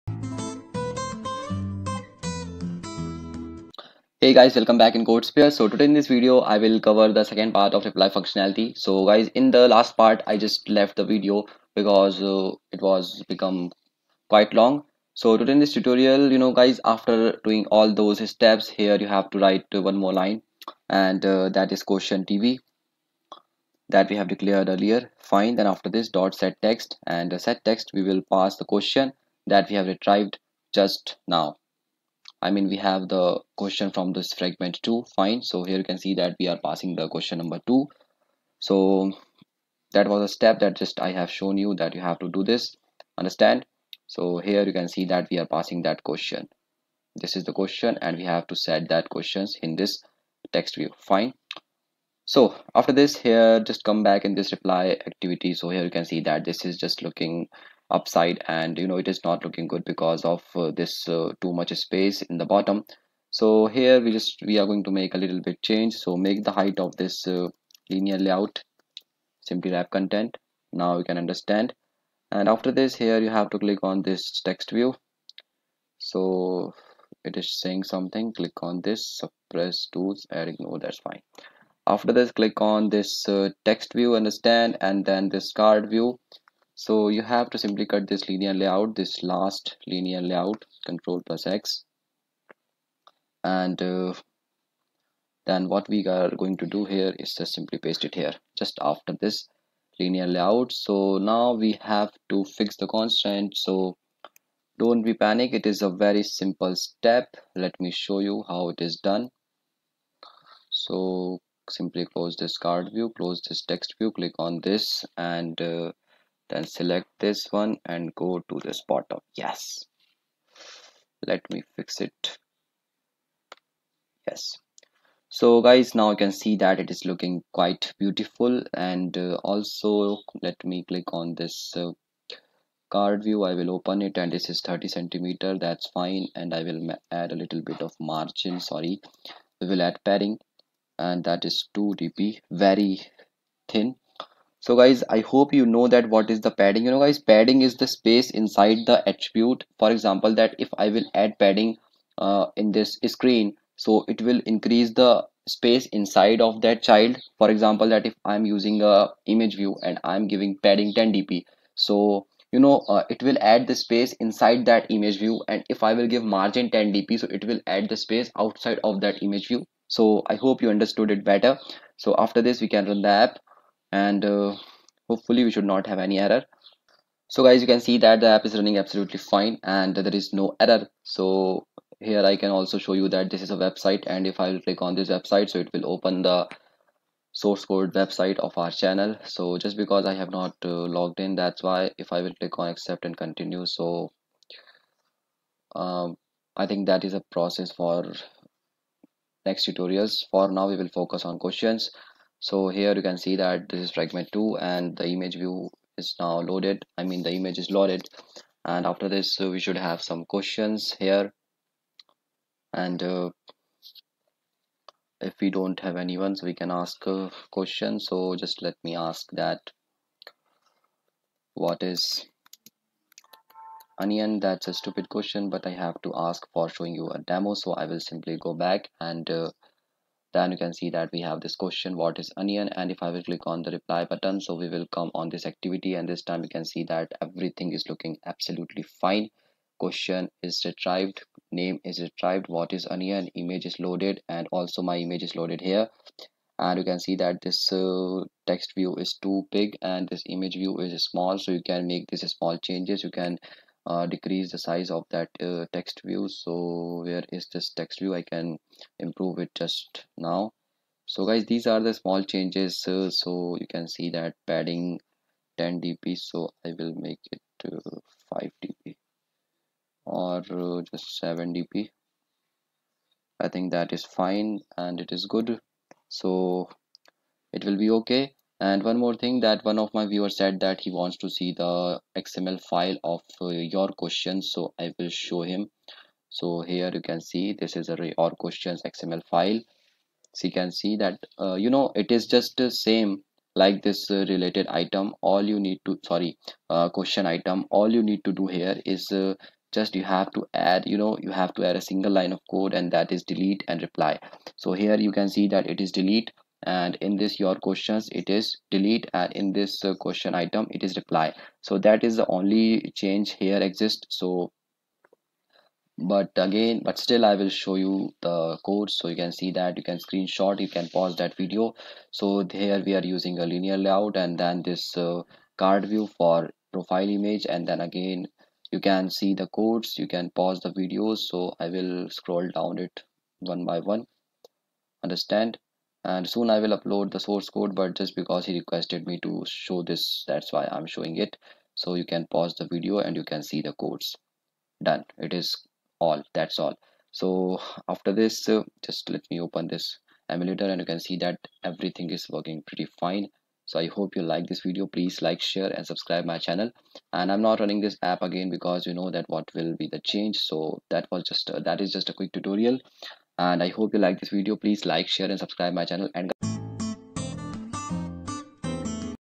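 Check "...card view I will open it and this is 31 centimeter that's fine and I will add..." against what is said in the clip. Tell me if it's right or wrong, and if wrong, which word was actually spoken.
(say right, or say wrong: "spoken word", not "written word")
wrong: "30", not "31".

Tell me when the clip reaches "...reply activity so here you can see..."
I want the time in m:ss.
0:54.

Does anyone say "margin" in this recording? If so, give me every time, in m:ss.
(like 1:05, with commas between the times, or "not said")
2:17, 2:46.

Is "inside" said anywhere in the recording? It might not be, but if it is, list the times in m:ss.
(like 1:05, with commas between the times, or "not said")
2:28, 2:35, 2:44.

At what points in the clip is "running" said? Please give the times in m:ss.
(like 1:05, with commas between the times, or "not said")
2:58, 5:57.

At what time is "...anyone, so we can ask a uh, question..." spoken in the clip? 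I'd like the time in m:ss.
3:35.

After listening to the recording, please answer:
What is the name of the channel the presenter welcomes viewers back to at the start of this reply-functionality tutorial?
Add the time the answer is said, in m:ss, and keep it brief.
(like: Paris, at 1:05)
CodeSphere, at 0:05.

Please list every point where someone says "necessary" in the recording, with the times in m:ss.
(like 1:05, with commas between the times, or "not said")
not said.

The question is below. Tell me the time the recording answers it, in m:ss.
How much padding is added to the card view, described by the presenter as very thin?
2:21.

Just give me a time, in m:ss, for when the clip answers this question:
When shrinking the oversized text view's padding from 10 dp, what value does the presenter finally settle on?
4:31.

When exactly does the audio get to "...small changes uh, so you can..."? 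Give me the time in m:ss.
4:21.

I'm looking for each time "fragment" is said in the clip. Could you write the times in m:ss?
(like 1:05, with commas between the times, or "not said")
0:34, 3:23.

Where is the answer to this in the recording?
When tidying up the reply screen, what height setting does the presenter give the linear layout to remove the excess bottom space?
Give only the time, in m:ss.
1:09.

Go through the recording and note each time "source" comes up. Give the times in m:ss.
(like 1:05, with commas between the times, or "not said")
3:07, 5:37.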